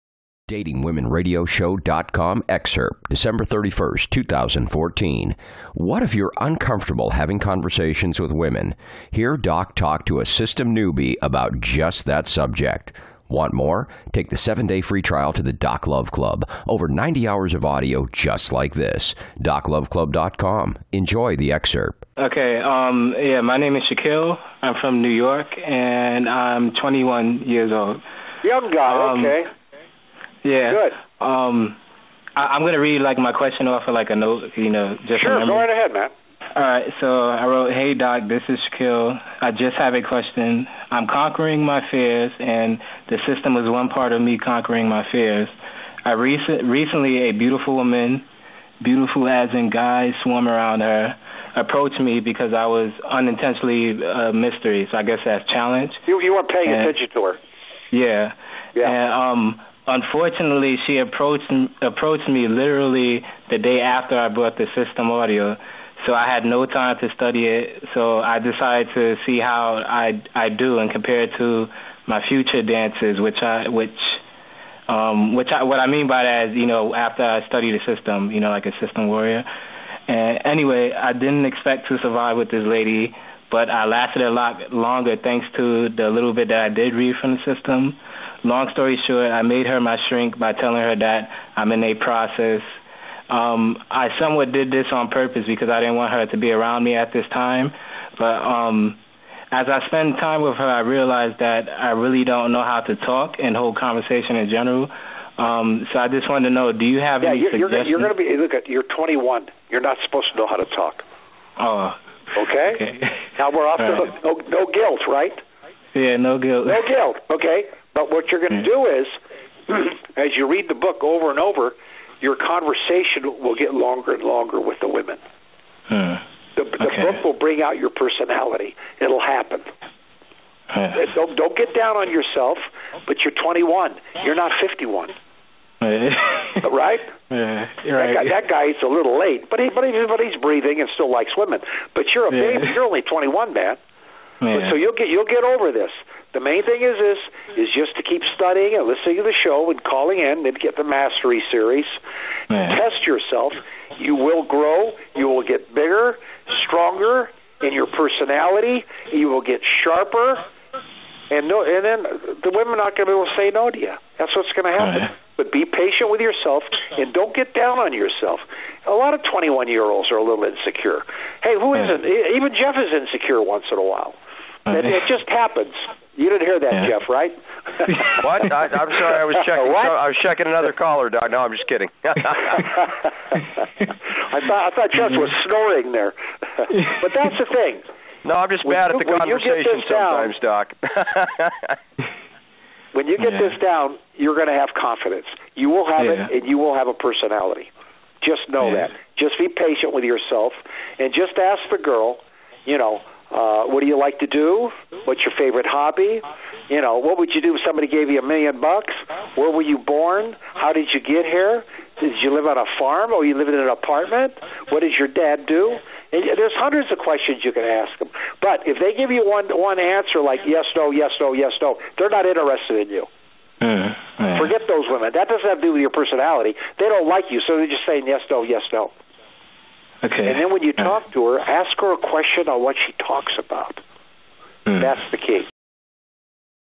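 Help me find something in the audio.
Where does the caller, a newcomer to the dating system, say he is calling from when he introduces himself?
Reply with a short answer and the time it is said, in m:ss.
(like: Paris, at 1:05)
New York, at 0:25.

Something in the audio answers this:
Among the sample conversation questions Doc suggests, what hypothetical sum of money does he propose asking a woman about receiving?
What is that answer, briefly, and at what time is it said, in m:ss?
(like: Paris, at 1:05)
a million bucks, at 3:28.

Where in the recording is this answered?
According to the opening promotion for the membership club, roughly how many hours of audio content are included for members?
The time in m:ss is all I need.
0:16.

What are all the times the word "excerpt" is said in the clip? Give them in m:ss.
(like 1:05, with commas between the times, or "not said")
0:02, 0:21.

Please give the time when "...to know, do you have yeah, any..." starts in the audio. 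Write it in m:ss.
1:46.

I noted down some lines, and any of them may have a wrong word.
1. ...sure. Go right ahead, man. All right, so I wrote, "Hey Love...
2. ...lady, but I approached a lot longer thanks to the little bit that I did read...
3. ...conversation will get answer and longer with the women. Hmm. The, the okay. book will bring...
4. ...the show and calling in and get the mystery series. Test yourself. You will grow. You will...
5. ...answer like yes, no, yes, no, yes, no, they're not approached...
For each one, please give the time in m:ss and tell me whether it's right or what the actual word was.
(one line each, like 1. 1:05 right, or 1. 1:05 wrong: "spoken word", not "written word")
1. 0:35 wrong: "Doc", not "Love"
2. 1:22 wrong: "lasted", not "approached"
3. 2:02 wrong: "longer", not "answer"
4. 2:29 wrong: "mastery", not "mystery"
5. 3:39 wrong: "interested", not "approached".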